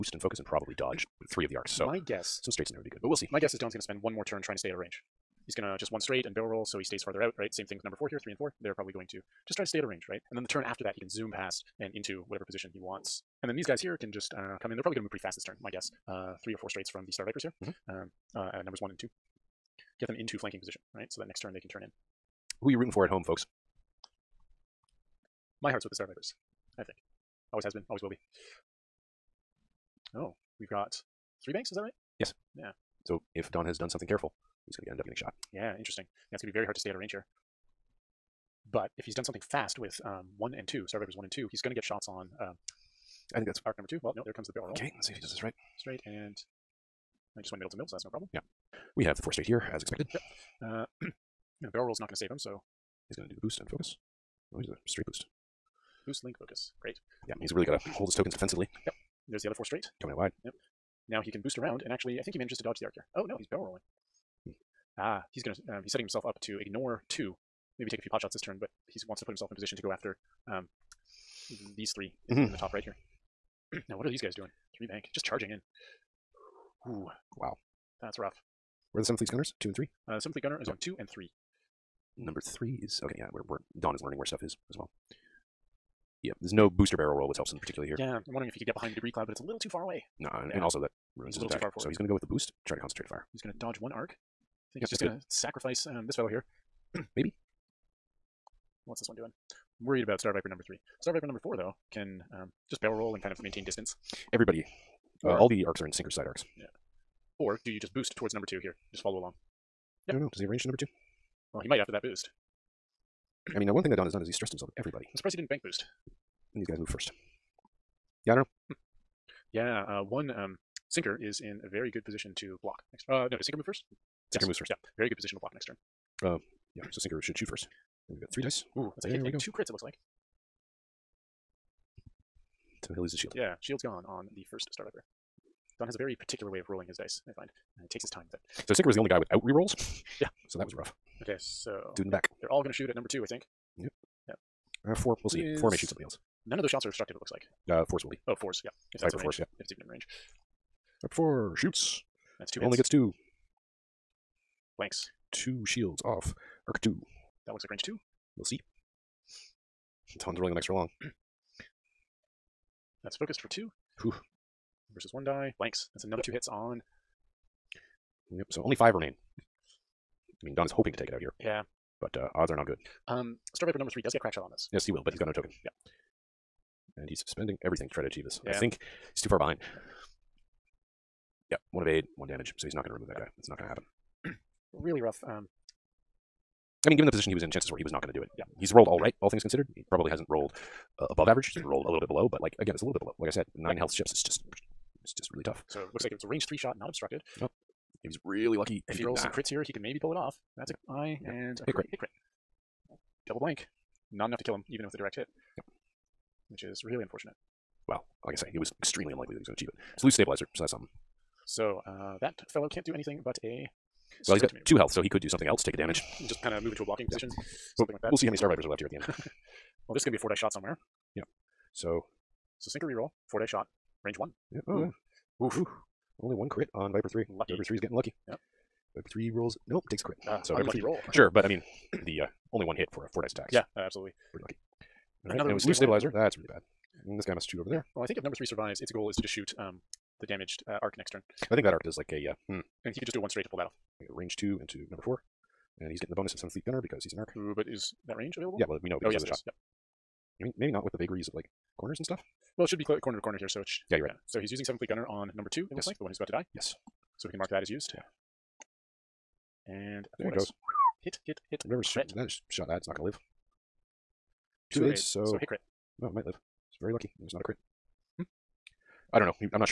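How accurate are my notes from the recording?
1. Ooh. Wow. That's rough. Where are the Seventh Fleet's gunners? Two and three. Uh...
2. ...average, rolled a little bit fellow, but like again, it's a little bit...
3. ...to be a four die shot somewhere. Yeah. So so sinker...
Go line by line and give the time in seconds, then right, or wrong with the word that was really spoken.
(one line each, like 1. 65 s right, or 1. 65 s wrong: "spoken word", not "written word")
1. 76 s right
2. 191 s wrong: "below", not "fellow"
3. 220 s right.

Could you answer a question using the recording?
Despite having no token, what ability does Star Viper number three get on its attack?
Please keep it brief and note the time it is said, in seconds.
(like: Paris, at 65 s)
Crack shot, at 174 s.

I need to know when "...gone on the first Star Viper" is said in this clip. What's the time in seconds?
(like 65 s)
133 s.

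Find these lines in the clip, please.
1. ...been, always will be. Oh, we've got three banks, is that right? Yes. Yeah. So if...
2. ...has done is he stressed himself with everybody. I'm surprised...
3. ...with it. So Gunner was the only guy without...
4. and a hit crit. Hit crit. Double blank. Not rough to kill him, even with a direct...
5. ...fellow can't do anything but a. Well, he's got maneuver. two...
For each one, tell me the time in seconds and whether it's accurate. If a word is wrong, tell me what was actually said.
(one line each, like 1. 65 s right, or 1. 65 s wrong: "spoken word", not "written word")
1. 27 s right
2. 114 s right
3. 138 s wrong: "Sinker", not "Gunner"
4. 201 s wrong: "enough", not "rough"
5. 212 s right.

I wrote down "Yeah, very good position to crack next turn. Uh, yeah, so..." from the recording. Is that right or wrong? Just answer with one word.
wrong.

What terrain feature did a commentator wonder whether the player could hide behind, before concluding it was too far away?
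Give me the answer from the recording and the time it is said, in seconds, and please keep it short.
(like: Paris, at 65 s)
Debris cloud, at 88 s.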